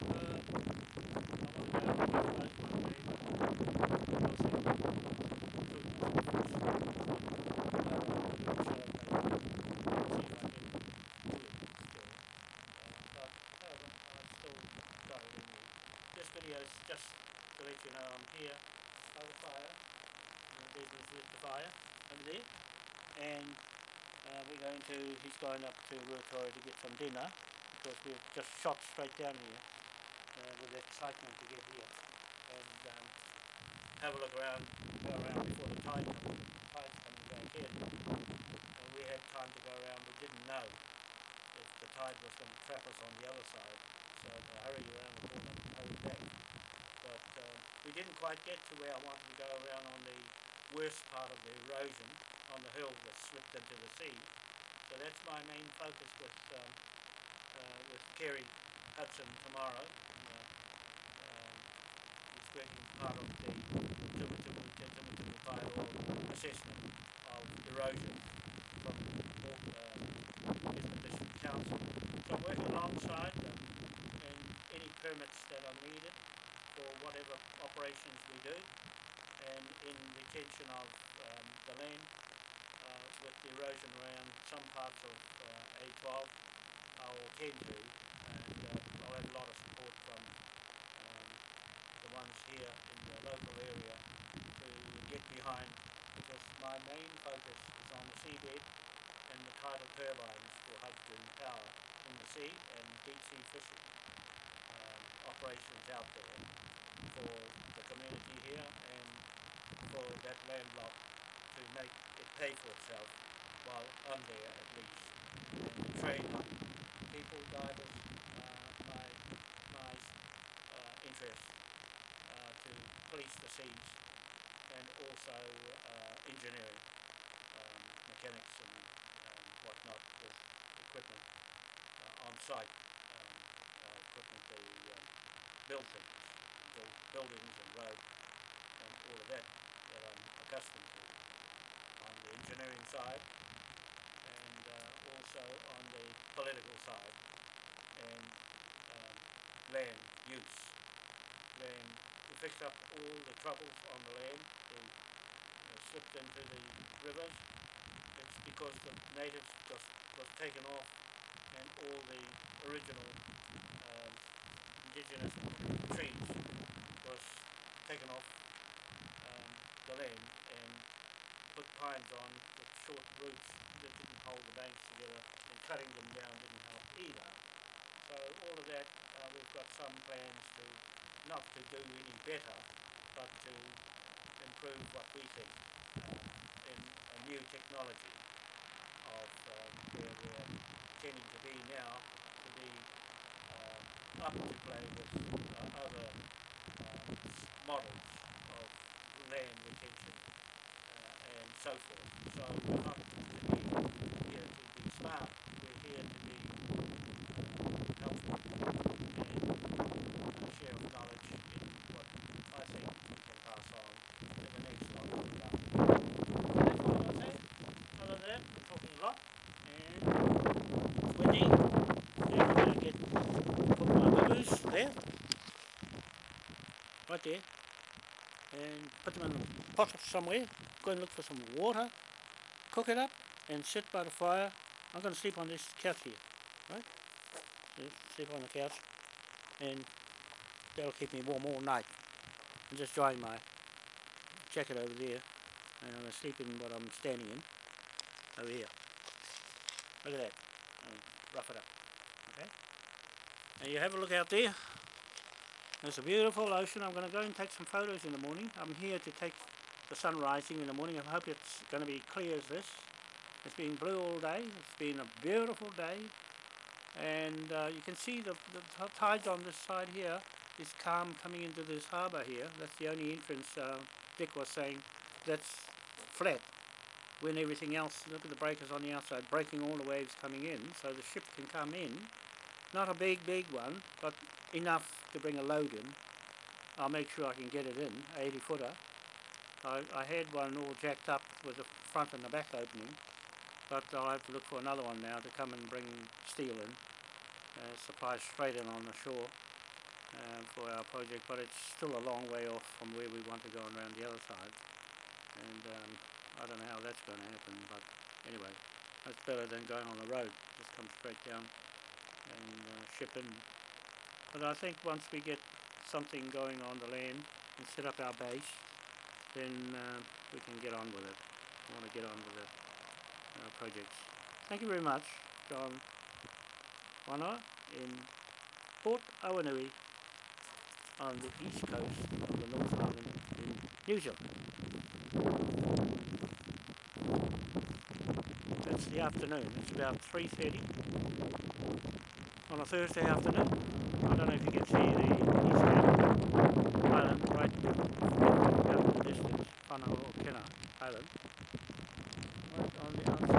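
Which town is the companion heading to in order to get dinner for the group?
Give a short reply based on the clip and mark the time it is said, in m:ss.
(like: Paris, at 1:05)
Ruatoria, at 0:26.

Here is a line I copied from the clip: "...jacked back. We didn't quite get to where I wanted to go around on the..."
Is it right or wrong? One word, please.
wrong.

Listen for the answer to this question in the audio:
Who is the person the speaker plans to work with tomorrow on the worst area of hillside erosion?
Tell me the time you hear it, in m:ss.
0:58.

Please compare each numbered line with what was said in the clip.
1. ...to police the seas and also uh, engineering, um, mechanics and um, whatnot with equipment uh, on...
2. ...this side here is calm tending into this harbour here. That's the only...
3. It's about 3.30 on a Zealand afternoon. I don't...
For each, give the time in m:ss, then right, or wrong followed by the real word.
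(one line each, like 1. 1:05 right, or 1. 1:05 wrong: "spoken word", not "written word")
1. 2:02 right
2. 4:29 wrong: "coming", not "tending"
3. 5:39 wrong: "Thursday", not "Zealand".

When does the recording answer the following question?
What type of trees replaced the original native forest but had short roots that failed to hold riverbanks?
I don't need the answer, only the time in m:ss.
2:51.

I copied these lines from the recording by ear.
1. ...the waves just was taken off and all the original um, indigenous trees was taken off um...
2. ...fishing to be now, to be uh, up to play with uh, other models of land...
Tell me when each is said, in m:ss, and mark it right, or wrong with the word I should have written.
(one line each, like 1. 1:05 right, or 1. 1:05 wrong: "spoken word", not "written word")
1. 2:38 wrong: "natives", not "waves"
2. 3:11 wrong: "tending", not "fishing".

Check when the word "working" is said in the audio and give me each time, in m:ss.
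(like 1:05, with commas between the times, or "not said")
1:02, 1:12.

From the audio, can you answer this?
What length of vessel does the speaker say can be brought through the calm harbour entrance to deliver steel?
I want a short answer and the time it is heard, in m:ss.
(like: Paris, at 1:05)
80 footer, at 4:48.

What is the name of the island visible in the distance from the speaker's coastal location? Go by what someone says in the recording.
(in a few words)
Panaokena Island.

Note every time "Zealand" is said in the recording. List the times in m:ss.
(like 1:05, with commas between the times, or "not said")
5:33.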